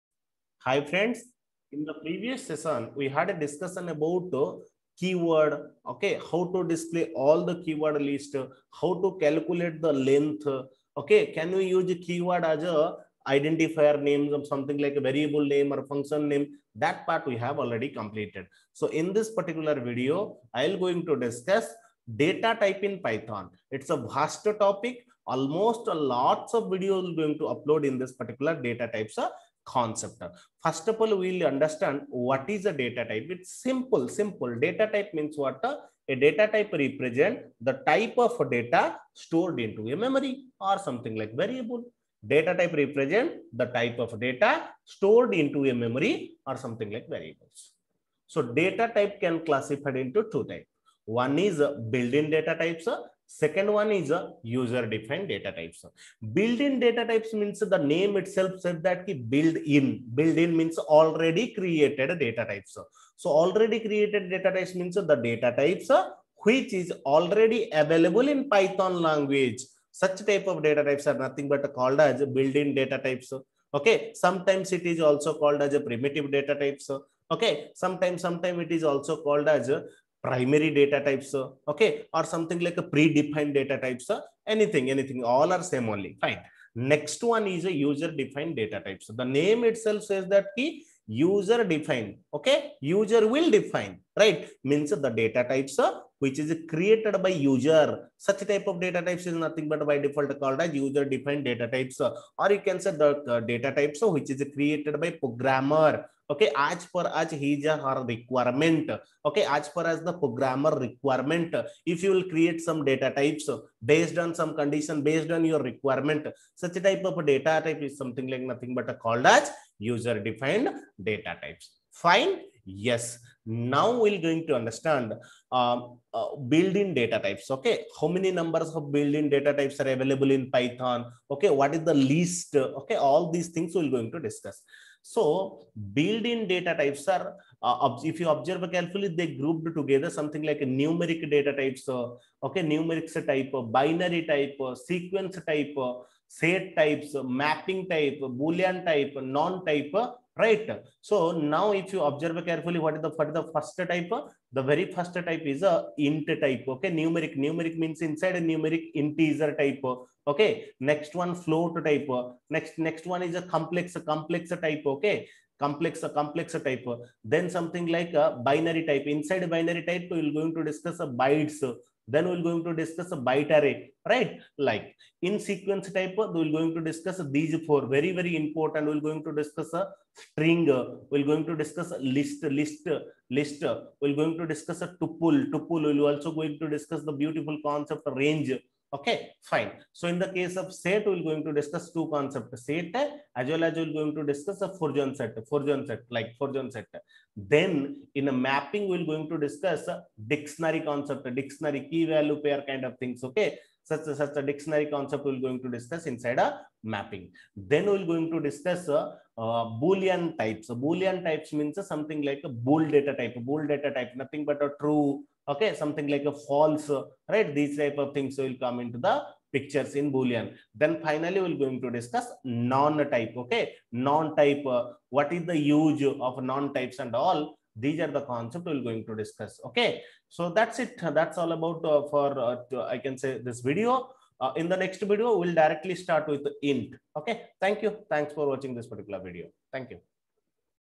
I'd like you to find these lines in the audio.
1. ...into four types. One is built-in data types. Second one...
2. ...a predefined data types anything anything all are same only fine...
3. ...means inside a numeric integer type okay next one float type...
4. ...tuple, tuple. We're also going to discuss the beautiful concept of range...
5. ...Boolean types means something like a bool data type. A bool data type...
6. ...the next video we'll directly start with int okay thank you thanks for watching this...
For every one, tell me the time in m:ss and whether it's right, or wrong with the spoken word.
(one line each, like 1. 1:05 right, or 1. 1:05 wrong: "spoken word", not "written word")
1. 0:49 wrong: "two", not "four"
2. 1:22 right
3. 2:37 right
4. 3:05 right
5. 3:30 right
6. 3:54 right.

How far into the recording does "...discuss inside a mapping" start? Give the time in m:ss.
3:25.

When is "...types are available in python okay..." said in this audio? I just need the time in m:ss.
2:09.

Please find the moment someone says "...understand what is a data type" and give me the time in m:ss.
0:31.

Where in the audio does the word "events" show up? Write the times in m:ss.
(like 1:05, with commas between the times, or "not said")
not said.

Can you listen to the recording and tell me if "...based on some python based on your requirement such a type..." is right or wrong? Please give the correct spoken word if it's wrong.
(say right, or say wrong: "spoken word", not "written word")
wrong: "condition", not "python".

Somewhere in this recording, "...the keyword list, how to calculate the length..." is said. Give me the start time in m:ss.
0:07.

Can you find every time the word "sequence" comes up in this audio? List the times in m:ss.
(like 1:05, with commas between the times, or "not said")
2:24, 2:55.